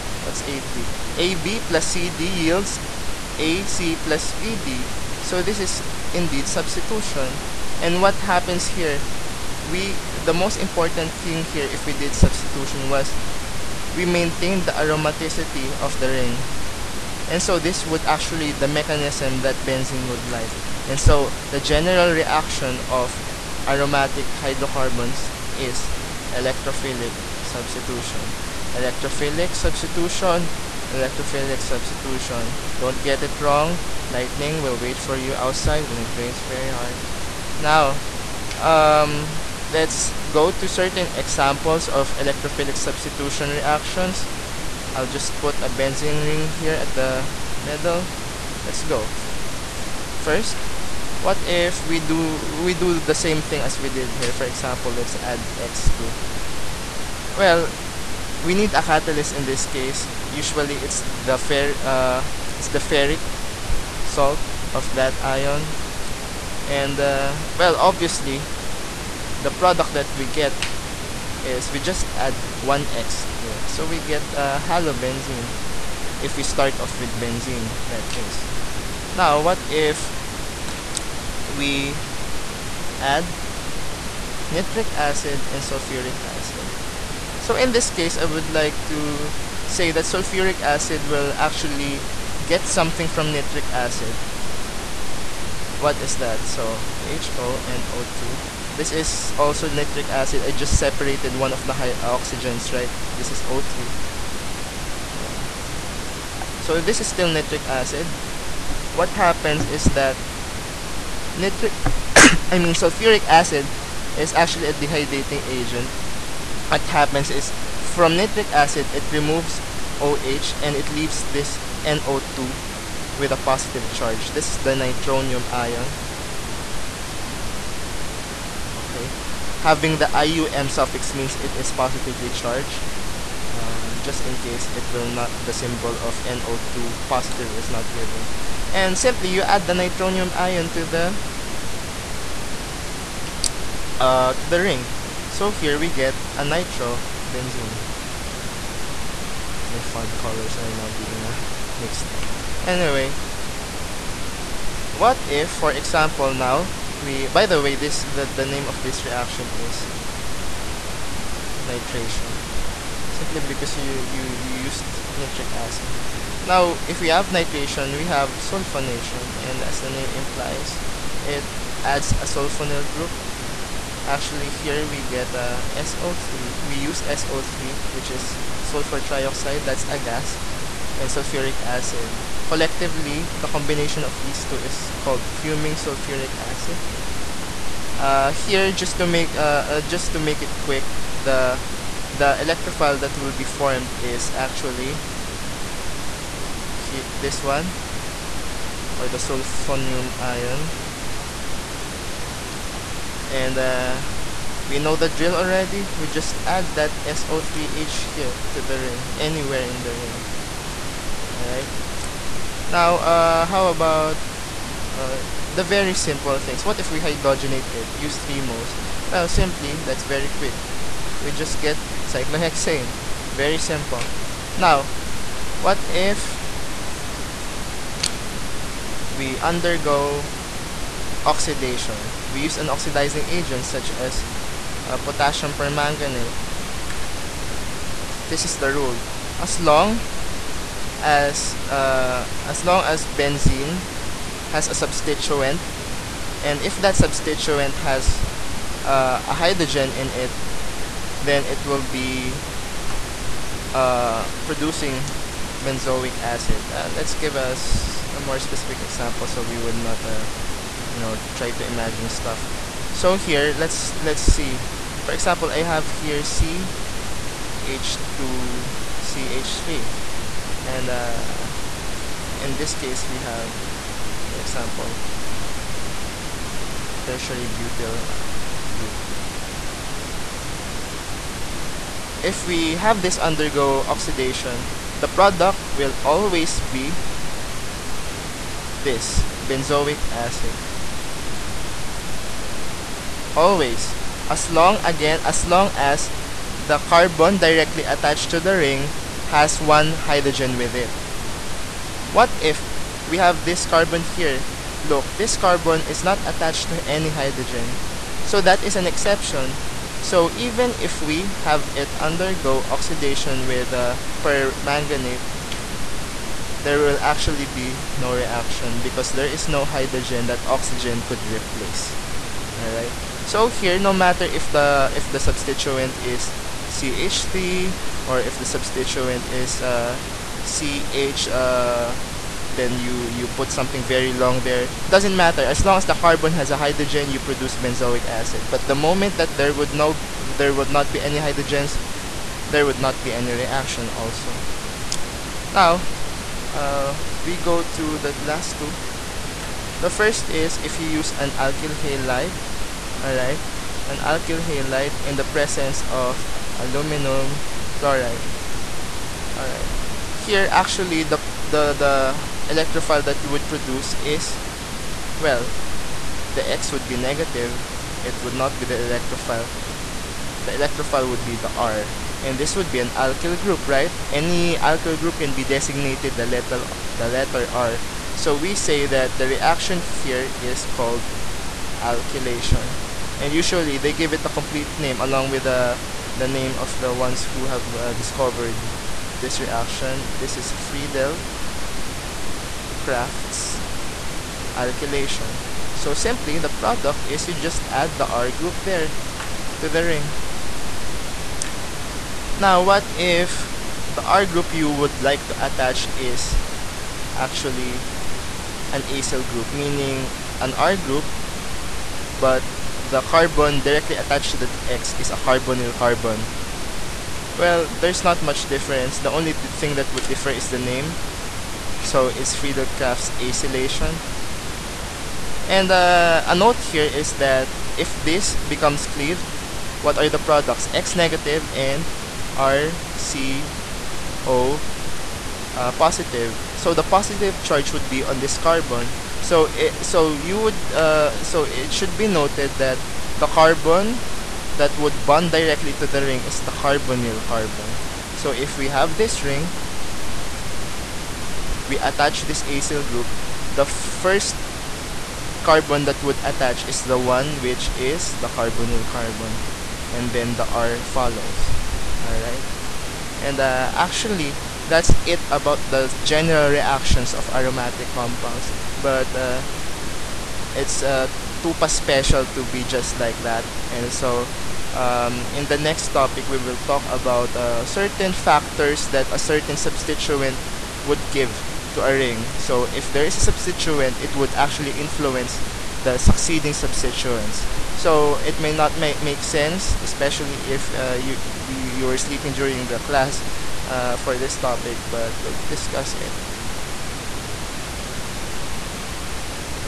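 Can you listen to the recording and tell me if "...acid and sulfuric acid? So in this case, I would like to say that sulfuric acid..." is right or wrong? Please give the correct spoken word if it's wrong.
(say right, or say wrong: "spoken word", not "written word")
right.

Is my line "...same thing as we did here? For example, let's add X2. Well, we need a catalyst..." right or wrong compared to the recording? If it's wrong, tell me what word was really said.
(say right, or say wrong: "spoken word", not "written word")
right.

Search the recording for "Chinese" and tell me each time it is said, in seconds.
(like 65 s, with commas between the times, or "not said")
not said.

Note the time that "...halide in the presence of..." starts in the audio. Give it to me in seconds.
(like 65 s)
354 s.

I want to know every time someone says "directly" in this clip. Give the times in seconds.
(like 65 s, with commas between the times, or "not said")
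297 s, 413 s, 445 s.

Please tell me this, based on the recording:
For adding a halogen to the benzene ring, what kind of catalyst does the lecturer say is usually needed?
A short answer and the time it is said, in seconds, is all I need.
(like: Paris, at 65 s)
Ferric salt, at 62 s.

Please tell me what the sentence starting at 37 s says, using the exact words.
Now, um, let's go to certain examples of electrophilic substitution reactions.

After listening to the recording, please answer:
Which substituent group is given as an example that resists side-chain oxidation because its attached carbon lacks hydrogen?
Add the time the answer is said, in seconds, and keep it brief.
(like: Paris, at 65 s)
Tertiary butyl, at 277 s.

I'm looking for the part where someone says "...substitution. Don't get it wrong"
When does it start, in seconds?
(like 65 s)
31 s.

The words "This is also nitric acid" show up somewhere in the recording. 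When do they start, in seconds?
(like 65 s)
98 s.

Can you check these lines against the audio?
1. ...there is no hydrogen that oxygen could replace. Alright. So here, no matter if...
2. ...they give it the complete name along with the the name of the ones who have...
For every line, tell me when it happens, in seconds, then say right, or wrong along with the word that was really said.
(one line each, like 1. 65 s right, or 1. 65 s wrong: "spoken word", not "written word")
1. 319 s right
2. 383 s right.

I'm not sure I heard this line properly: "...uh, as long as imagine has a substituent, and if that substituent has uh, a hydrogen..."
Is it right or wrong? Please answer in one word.
wrong.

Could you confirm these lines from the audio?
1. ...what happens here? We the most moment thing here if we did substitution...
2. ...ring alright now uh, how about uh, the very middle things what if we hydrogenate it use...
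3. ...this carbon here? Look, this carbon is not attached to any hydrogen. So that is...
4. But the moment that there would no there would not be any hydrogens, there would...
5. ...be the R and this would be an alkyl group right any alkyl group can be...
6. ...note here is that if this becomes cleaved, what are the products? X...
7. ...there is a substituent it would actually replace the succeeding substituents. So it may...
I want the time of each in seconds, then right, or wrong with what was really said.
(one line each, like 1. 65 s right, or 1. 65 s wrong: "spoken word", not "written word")
1. 8 s wrong: "important", not "moment"
2. 209 s wrong: "simple", not "middle"
3. 303 s right
4. 338 s right
5. 371 s right
6. 426 s right
7. 482 s wrong: "influence", not "replace".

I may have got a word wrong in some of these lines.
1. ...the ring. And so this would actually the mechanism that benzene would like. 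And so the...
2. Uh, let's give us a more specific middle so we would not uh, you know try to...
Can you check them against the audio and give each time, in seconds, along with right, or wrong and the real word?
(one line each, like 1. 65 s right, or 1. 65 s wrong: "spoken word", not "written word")
1. 15 s right
2. 256 s wrong: "example", not "middle".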